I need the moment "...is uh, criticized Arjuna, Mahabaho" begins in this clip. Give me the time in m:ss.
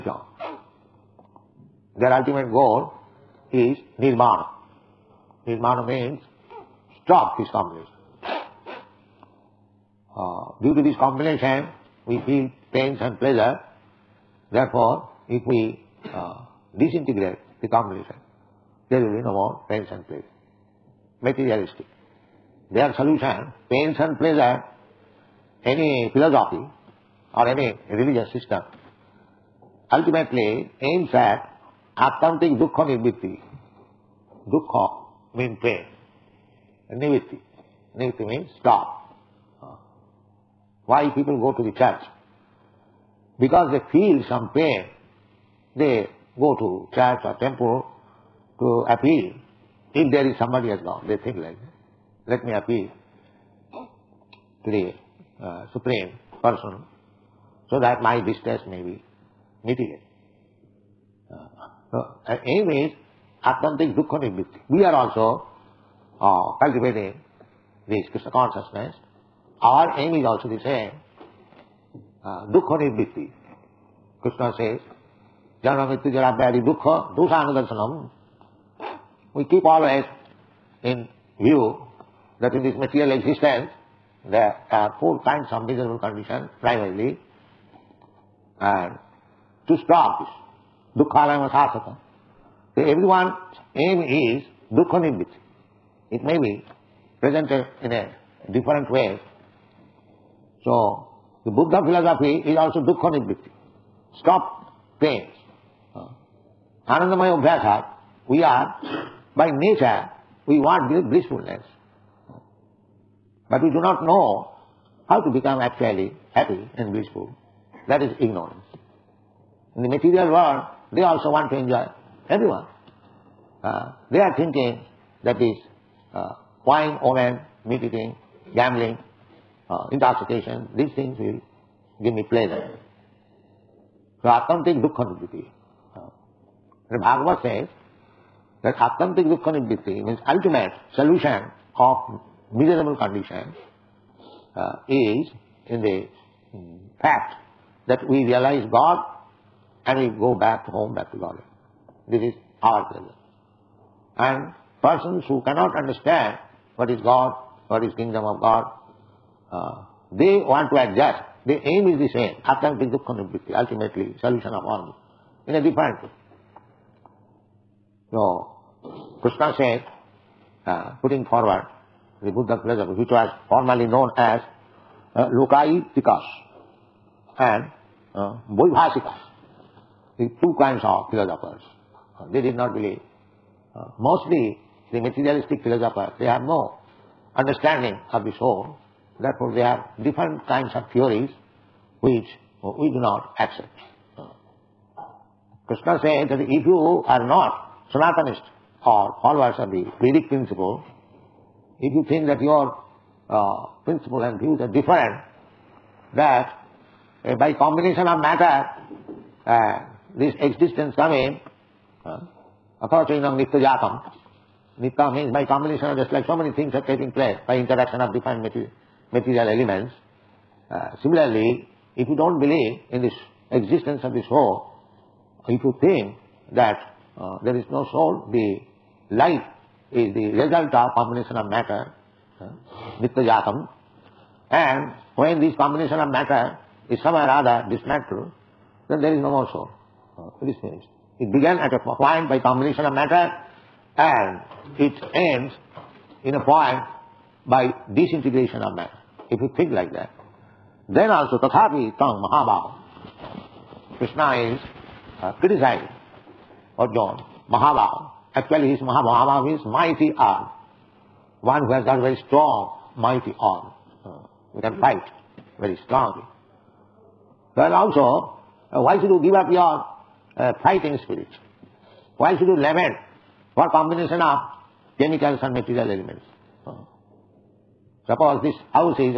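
4:14.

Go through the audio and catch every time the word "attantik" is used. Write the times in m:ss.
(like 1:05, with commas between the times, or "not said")
2:14, 2:18.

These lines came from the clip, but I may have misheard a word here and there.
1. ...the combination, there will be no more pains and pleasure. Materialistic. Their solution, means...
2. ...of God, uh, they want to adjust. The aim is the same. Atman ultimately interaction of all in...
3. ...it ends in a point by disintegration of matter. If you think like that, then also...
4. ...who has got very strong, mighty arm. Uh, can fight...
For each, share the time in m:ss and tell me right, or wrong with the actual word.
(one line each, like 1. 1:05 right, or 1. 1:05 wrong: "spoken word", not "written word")
1. 0:17 wrong: "pains", not "means"
2. 2:38 wrong: "solution", not "interaction"
3. 4:04 right
4. 4:21 right.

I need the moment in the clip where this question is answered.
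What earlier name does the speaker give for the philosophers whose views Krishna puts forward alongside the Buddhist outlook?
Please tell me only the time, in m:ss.
2:55.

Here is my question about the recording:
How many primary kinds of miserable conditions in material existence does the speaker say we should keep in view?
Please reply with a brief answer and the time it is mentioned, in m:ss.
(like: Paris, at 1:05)
4, at 1:24.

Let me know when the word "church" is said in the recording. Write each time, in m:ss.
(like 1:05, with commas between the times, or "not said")
0:41, 0:46.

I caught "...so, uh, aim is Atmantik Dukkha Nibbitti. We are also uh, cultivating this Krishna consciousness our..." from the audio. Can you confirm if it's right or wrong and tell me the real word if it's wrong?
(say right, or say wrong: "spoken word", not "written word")
right.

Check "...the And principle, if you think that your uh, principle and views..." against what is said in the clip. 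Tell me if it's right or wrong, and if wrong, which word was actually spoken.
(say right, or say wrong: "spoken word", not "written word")
wrong: "Vedic", not "And".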